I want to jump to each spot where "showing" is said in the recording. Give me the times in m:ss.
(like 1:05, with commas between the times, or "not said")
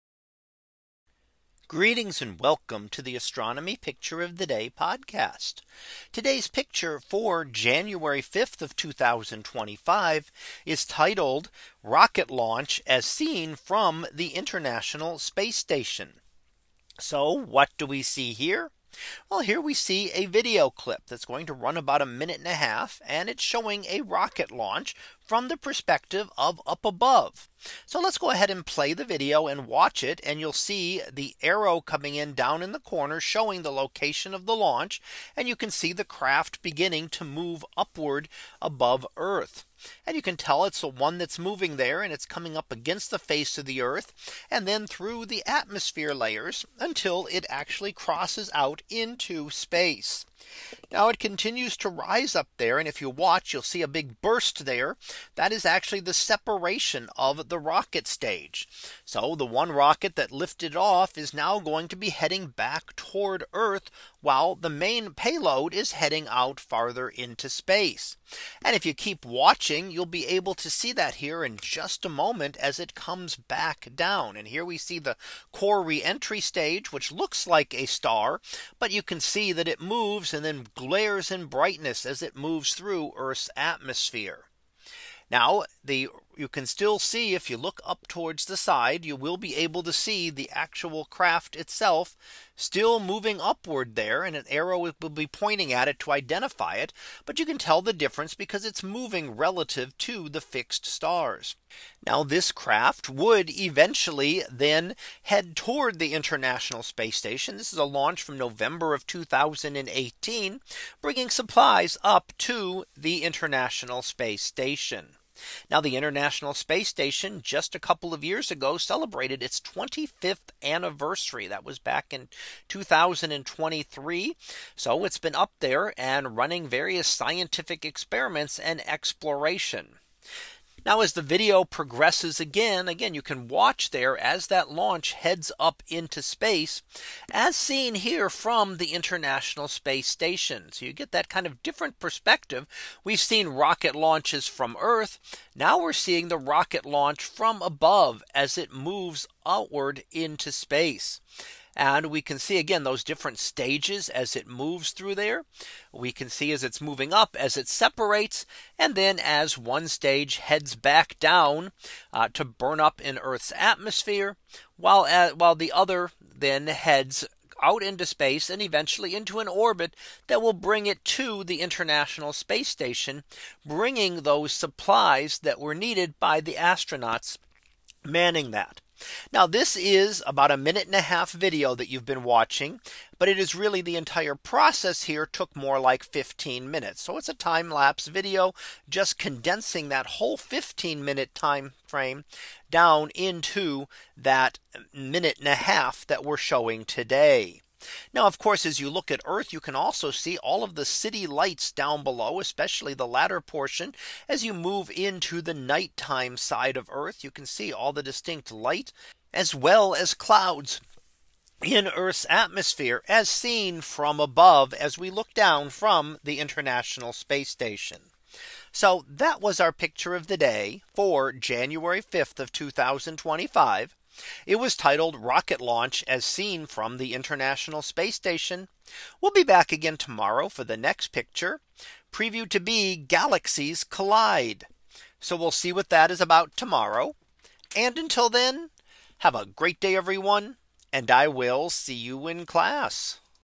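0:23, 0:33, 3:16.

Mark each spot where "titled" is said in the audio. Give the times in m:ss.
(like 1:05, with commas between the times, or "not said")
0:10, 3:44.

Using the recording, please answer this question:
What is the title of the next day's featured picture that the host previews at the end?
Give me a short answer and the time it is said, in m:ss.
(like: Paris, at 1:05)
Galaxies Collide, at 3:52.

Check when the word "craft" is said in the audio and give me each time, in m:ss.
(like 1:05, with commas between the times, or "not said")
0:36, 1:31, 1:42.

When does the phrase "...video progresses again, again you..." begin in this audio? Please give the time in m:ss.
2:11.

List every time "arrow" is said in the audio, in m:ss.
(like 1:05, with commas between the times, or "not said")
0:31, 1:34.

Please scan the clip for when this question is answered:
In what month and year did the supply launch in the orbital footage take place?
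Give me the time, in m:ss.
1:48.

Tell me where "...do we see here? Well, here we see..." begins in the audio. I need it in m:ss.
0:17.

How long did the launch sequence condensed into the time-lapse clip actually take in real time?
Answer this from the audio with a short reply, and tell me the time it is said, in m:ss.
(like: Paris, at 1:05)
15 minutes, at 3:06.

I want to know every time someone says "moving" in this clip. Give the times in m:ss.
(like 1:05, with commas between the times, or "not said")
0:41, 1:32, 1:38, 2:36.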